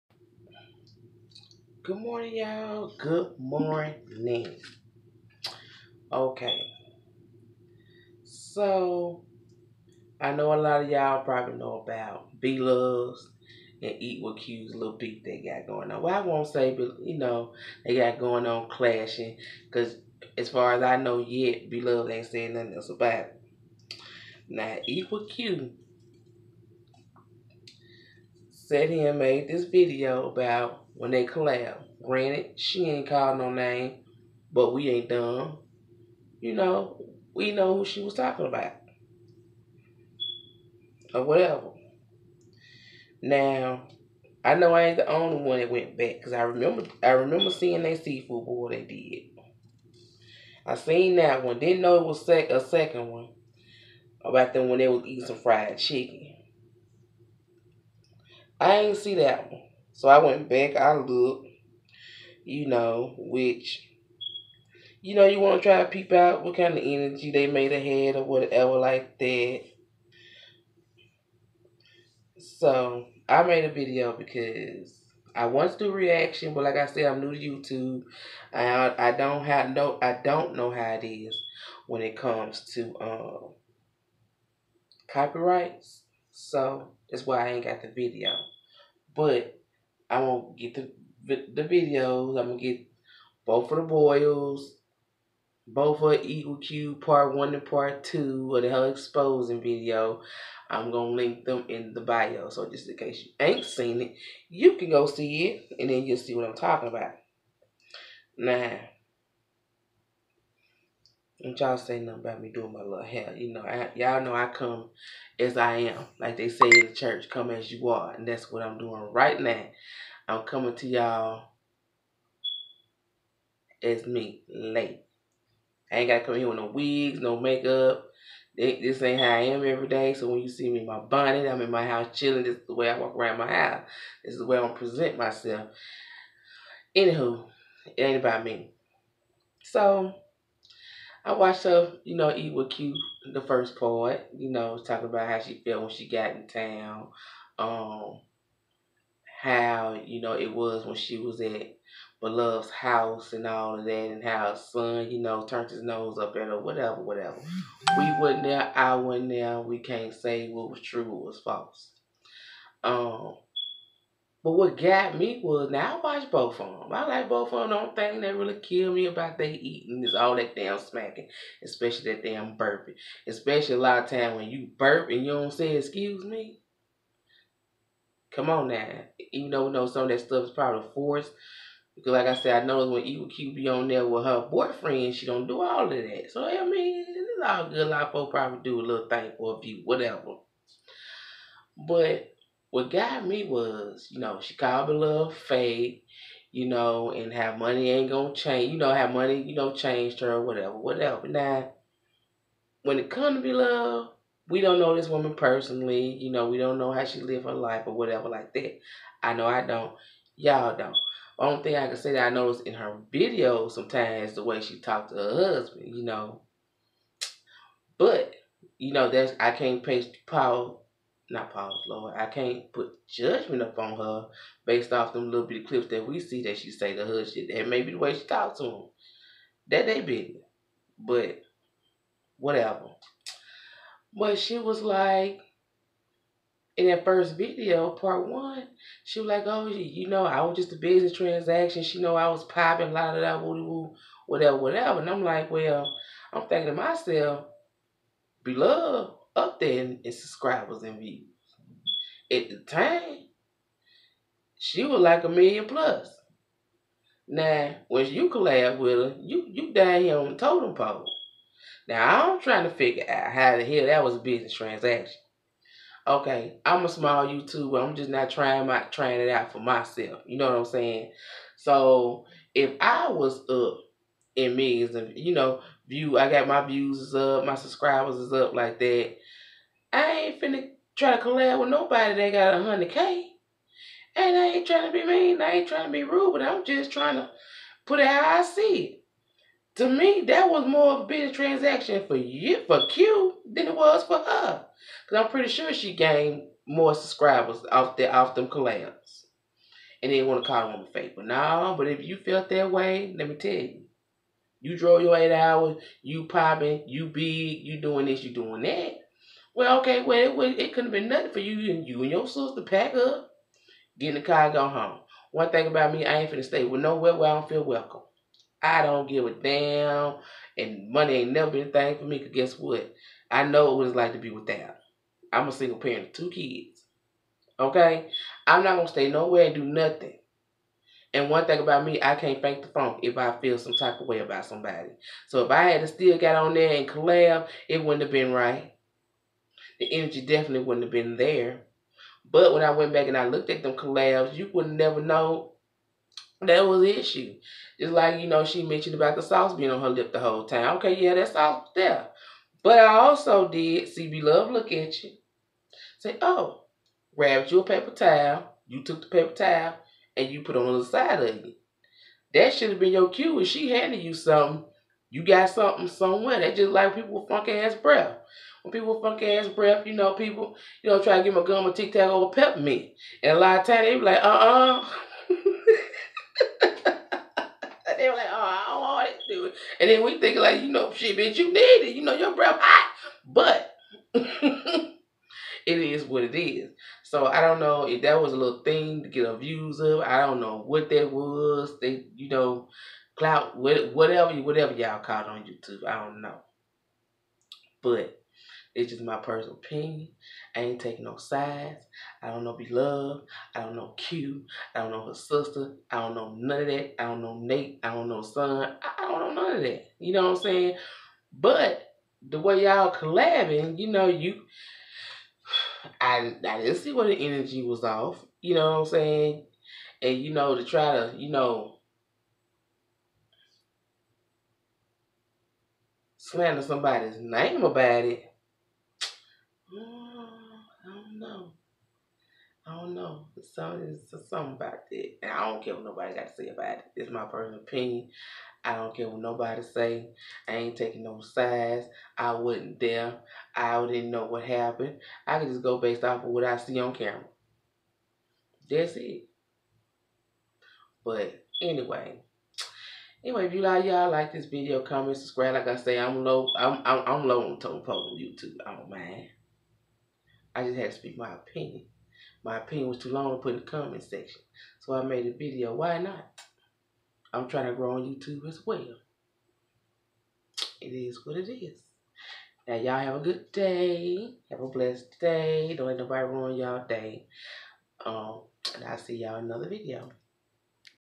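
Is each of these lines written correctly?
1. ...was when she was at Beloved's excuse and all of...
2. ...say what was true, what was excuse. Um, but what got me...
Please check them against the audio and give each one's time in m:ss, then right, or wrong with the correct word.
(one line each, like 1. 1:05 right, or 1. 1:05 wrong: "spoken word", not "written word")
1. 2:30 wrong: "house", not "excuse"
2. 2:40 wrong: "false", not "excuse".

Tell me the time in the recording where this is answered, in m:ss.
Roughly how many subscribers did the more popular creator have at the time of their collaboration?
4:15.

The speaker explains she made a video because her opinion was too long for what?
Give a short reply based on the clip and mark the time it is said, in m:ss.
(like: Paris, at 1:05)
the comment section, at 7:43.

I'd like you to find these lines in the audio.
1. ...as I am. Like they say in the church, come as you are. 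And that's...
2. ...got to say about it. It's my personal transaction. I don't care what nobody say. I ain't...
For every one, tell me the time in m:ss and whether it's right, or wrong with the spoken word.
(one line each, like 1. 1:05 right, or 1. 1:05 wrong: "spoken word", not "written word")
1. 1:55 right
2. 7:16 wrong: "opinion", not "transaction".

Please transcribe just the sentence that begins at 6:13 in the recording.
And a lot of times they be like, uh uh-uh.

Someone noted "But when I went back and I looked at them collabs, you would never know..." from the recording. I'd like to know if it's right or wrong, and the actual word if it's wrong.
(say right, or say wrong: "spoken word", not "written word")
right.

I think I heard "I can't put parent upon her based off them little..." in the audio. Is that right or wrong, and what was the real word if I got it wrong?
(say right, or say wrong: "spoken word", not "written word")
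wrong: "judgment", not "parent".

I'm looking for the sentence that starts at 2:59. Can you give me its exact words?
Even though we know some of that stuff is probably forced.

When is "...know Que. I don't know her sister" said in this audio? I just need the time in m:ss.
6:43.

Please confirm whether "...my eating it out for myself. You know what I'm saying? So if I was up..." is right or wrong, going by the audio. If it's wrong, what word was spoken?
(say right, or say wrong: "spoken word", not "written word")
wrong: "trying", not "eating".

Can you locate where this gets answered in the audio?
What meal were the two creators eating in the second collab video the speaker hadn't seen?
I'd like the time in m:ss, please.
0:55.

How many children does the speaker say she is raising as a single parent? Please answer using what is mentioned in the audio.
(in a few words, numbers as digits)
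2.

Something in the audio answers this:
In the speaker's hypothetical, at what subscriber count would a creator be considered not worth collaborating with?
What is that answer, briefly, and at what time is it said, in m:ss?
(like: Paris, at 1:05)
100K, at 4:42.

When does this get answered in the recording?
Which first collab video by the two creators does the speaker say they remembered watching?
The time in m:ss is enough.
0:48.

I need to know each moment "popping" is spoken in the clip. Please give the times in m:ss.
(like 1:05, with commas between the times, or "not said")
4:02, 5:06.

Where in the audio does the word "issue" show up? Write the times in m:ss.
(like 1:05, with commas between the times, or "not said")
5:46.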